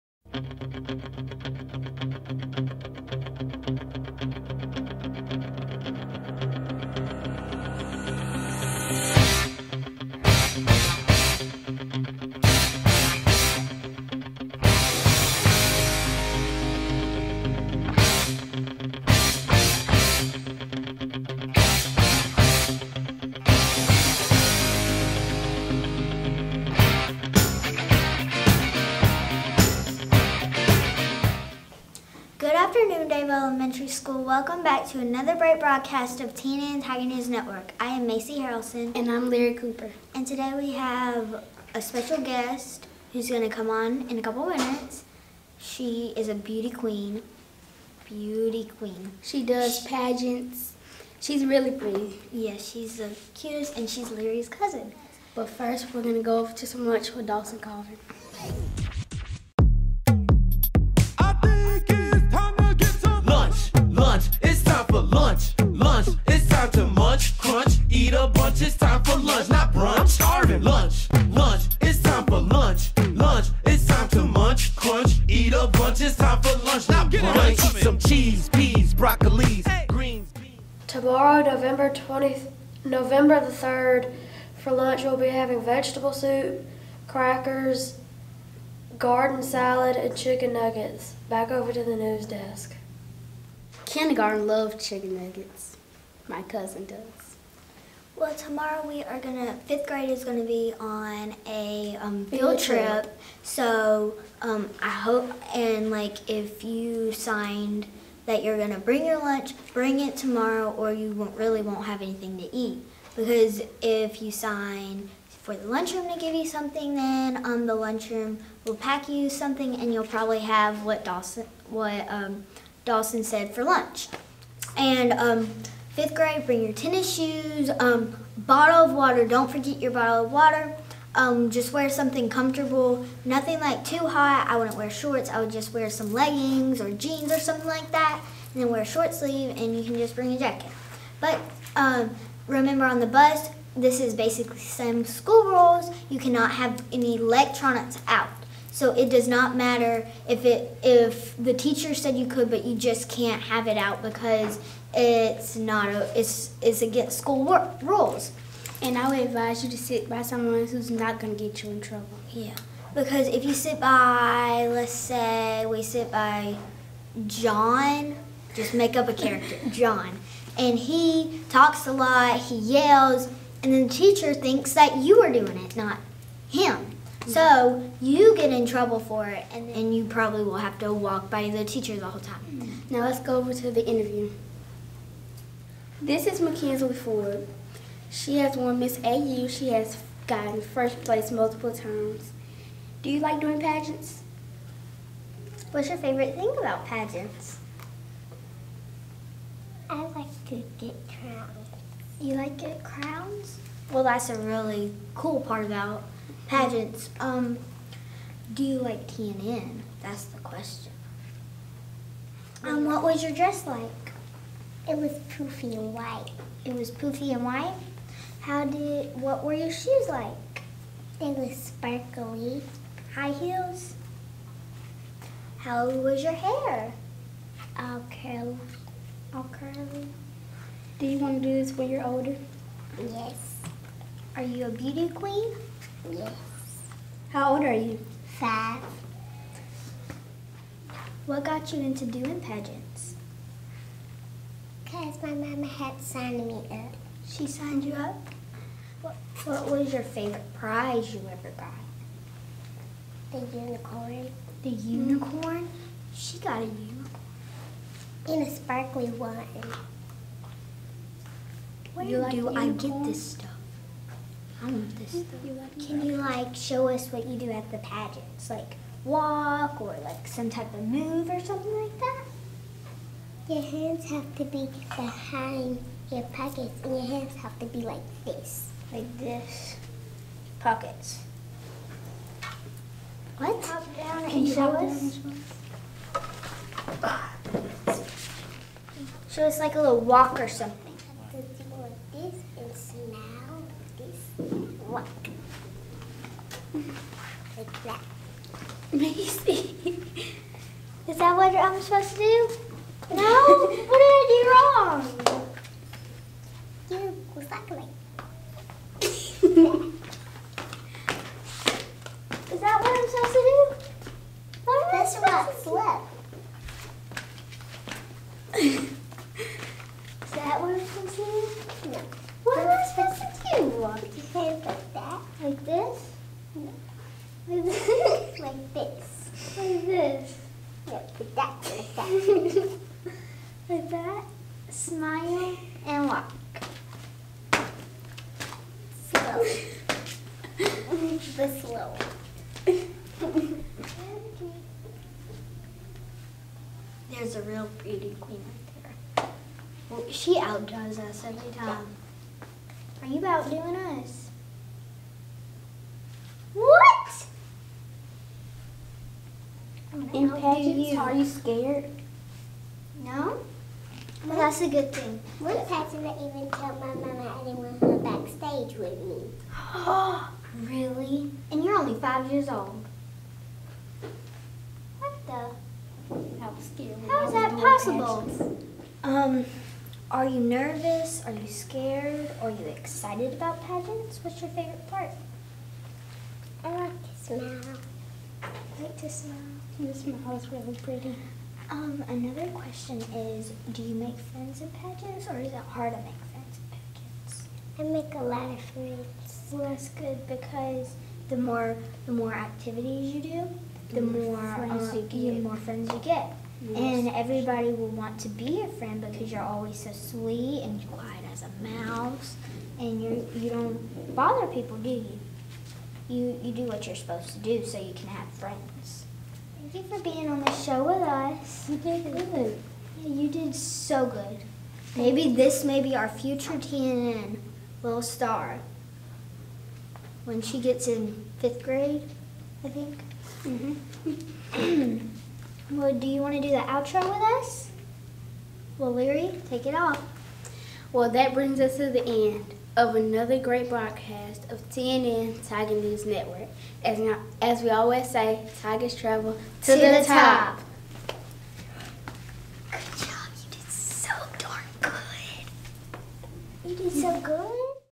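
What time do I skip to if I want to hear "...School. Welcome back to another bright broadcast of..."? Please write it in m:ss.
0:33.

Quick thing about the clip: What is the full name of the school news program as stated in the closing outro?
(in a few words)
TNN Tiger News Network.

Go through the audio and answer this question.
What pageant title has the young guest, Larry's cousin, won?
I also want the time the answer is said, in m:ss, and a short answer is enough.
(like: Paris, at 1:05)
Miss AU, at 3:08.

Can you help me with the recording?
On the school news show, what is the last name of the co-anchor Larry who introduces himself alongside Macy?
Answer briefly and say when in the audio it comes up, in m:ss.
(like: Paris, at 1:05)
Cooper, at 0:39.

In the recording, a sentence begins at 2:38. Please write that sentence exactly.
And I would advise you to sit by someone who's not going to get you in trouble.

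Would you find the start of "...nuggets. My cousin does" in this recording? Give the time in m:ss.
1:35.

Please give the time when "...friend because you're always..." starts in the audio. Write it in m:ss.
6:48.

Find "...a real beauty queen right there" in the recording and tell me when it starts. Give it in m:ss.
5:47.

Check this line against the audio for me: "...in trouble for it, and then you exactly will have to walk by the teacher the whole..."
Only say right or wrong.
wrong.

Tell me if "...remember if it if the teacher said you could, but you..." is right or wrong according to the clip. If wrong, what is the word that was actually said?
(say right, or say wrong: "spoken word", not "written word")
wrong: "matter", not "remember".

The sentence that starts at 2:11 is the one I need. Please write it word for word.
Um, just wear something comfortable, nothing like too hot.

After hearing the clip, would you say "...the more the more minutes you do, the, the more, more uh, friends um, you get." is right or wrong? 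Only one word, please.
wrong.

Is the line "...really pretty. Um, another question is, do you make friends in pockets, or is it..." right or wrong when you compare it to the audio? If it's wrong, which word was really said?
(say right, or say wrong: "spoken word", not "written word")
wrong: "pageants", not "pockets".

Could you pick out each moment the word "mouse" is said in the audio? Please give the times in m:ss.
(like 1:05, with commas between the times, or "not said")
6:51.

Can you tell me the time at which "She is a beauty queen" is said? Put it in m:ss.
0:45.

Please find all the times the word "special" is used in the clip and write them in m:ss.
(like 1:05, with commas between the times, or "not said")
0:41.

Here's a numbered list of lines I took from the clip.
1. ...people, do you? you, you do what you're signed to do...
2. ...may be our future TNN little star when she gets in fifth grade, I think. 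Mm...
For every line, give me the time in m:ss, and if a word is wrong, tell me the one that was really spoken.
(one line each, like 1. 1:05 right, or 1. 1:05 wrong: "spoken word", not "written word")
1. 6:54 wrong: "supposed", not "signed"
2. 7:05 right.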